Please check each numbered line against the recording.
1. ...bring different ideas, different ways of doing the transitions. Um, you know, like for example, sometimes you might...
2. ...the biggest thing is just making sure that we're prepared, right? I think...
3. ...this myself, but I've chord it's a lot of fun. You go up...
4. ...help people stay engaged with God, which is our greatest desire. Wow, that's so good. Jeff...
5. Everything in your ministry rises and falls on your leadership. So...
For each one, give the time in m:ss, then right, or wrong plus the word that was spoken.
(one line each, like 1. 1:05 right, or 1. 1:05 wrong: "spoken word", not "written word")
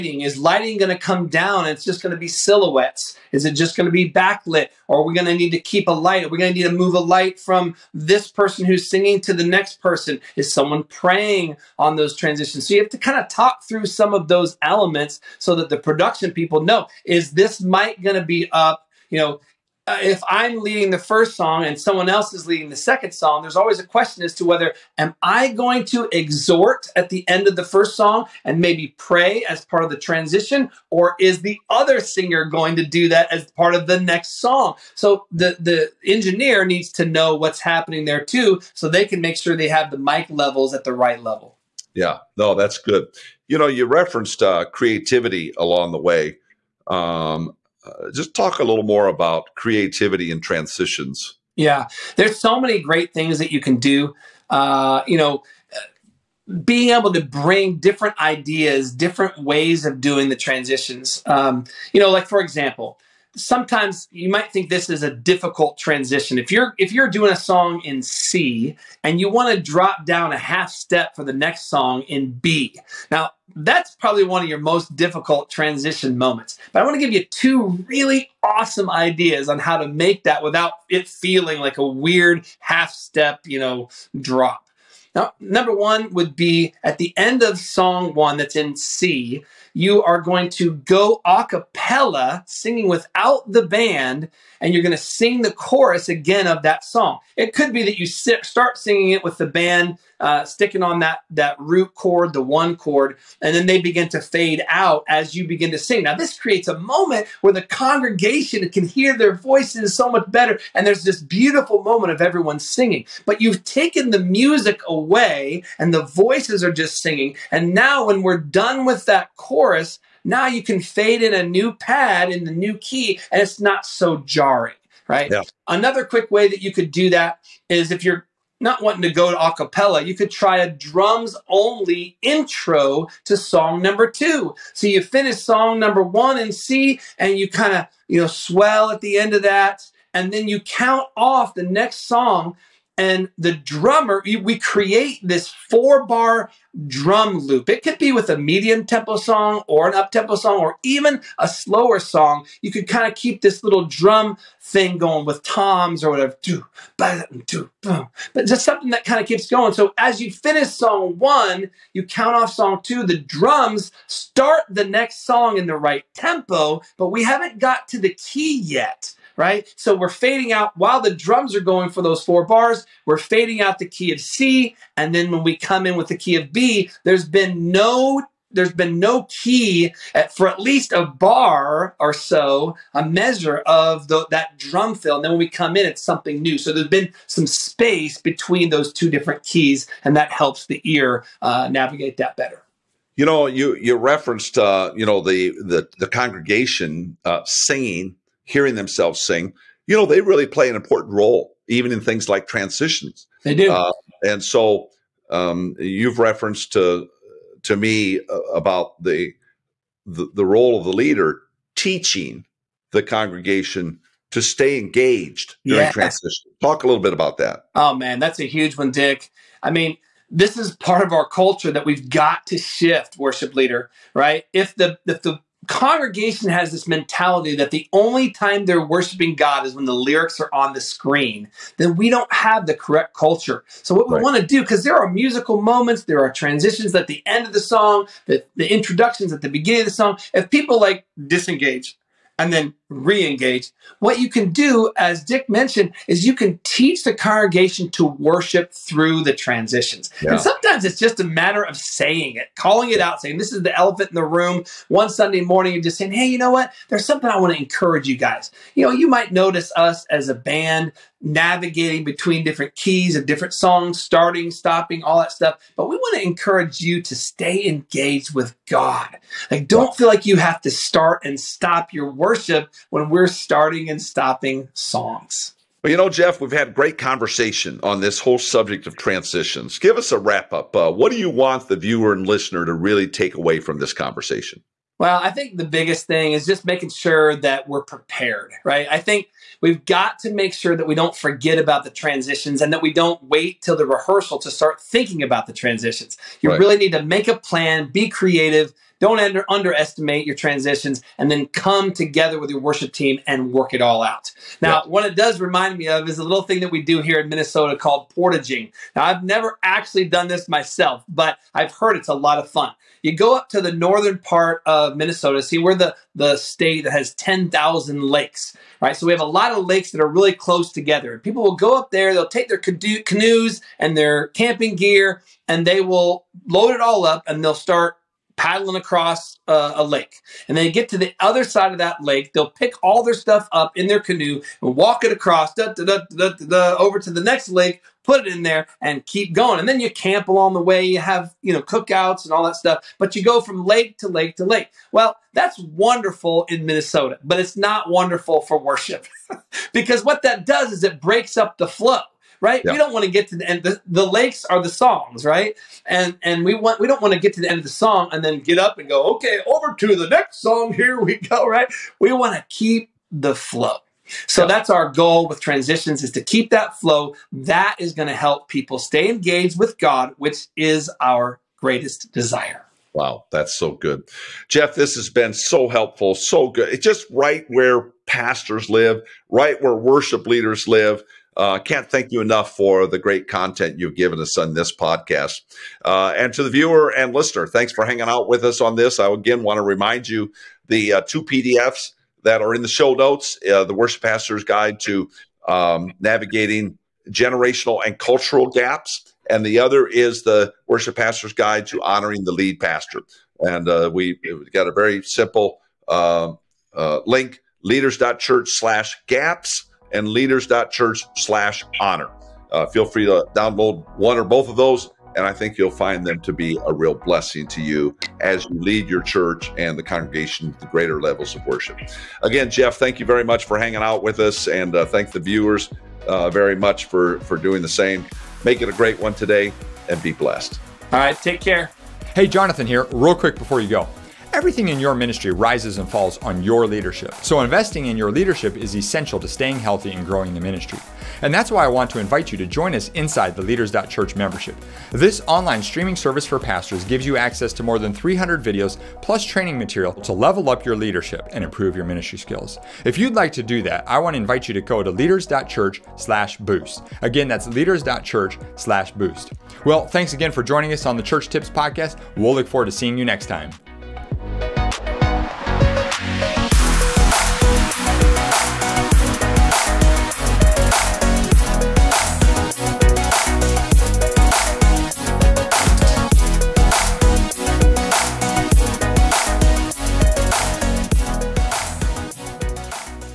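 1. 0:57 right
2. 4:45 right
3. 5:10 wrong: "heard", not "chord"
4. 6:08 right
5. 7:14 right.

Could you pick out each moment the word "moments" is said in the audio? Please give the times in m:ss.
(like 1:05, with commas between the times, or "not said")
1:16, 1:46, 1:51, 3:55.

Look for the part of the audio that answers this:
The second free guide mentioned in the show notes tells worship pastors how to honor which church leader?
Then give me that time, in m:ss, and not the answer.
6:42.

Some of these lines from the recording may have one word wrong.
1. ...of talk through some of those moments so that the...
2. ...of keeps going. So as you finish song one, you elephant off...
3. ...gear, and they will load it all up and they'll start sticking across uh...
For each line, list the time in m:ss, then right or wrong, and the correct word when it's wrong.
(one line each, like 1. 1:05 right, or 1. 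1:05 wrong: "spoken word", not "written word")
1. 0:13 wrong: "elements", not "moments"
2. 2:39 wrong: "count", not "elephant"
3. 5:24 wrong: "paddling", not "sticking".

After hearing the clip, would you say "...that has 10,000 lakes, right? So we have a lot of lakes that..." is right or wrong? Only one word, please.
right.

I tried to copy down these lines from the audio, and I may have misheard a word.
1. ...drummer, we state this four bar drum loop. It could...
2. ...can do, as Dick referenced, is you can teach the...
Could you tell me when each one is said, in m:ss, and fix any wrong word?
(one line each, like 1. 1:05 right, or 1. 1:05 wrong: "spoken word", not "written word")
1. 2:23 wrong: "create", not "state"
2. 4:04 wrong: "mentioned", not "referenced".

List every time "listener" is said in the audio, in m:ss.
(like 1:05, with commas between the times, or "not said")
4:42, 6:27.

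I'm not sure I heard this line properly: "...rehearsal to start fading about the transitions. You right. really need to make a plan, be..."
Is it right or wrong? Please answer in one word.
wrong.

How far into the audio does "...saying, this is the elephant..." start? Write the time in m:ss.
4:13.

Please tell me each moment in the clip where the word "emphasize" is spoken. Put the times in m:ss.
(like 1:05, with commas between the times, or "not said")
not said.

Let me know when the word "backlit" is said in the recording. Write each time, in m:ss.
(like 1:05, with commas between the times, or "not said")
0:04.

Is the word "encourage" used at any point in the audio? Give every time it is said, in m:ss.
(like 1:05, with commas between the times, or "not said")
4:17, 4:26.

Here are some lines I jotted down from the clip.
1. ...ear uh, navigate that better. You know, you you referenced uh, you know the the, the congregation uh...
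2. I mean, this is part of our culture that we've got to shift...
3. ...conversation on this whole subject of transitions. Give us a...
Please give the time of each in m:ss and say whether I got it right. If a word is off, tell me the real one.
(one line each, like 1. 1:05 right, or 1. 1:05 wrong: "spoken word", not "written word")
1. 3:10 right
2. 3:39 right
3. 4:36 right.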